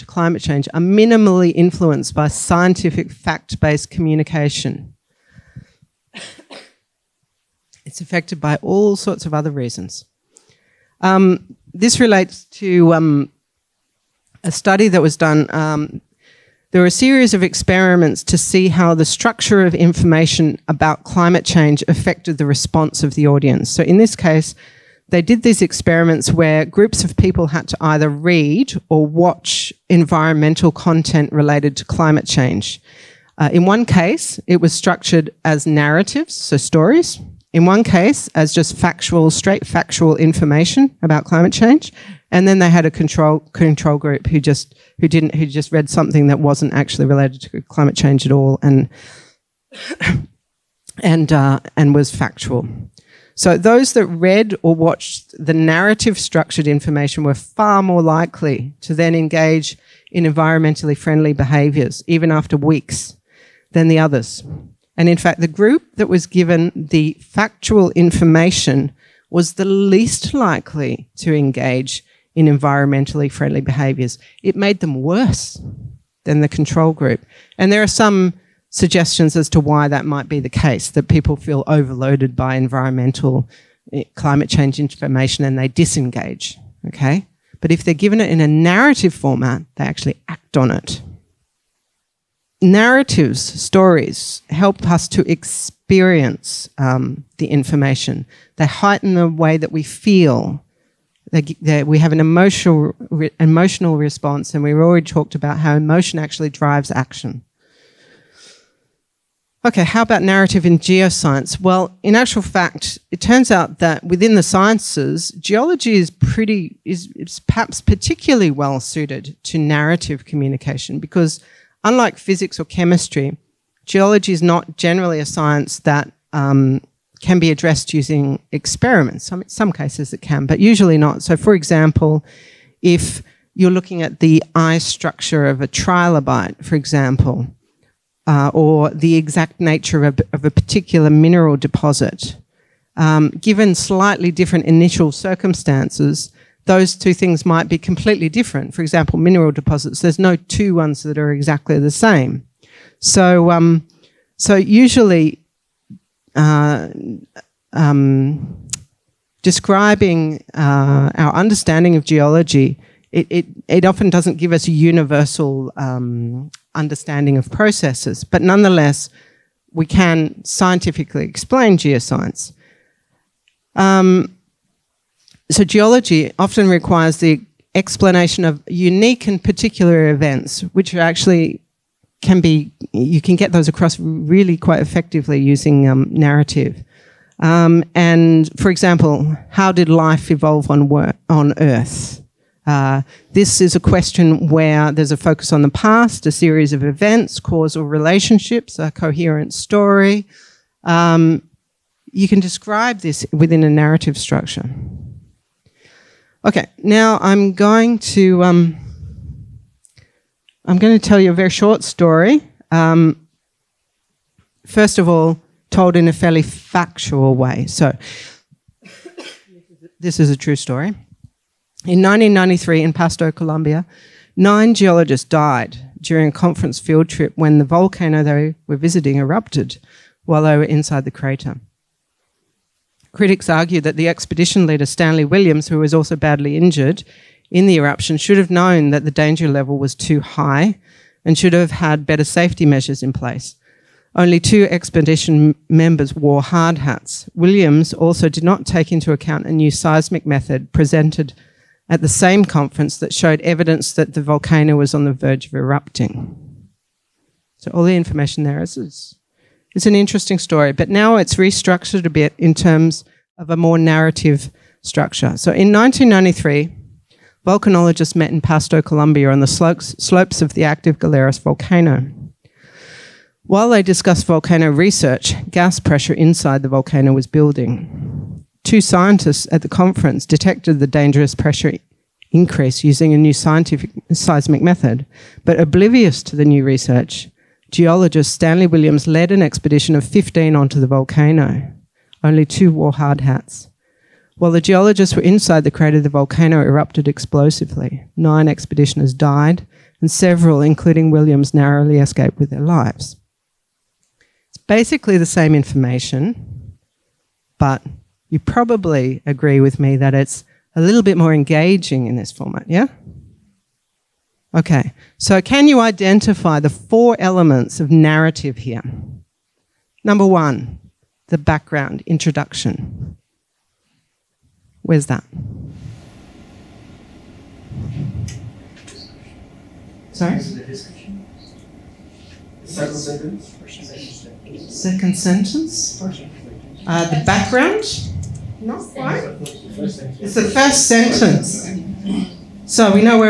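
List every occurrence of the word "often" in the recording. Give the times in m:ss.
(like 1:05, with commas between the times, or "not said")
2:43, 2:56.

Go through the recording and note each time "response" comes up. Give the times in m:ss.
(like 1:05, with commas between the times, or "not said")
0:22, 1:43.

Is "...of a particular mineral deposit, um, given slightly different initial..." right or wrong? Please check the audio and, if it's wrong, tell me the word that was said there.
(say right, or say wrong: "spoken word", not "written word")
right.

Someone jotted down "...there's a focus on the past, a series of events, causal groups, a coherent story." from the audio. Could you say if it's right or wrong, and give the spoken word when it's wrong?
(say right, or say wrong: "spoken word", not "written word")
wrong: "relationships", not "groups".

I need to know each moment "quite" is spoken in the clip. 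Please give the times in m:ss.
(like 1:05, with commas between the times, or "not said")
3:04, 5:38.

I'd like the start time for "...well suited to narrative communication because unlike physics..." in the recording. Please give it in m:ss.
1:58.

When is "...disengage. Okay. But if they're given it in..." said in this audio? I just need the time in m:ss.
1:25.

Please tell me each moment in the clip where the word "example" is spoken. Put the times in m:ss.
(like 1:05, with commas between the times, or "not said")
2:11, 2:16, 2:28, 3:08.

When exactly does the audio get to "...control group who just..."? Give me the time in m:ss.
0:43.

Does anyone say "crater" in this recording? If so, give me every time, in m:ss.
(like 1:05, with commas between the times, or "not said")
3:51, 4:55.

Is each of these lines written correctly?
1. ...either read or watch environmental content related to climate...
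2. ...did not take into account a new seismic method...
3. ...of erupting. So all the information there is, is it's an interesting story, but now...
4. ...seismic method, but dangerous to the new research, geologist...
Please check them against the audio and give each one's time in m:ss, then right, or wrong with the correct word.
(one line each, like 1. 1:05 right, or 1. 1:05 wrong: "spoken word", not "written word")
1. 0:27 right
2. 4:08 right
3. 4:15 right
4. 4:44 wrong: "oblivious", not "dangerous".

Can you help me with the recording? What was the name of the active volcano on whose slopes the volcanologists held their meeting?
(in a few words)
Galeras.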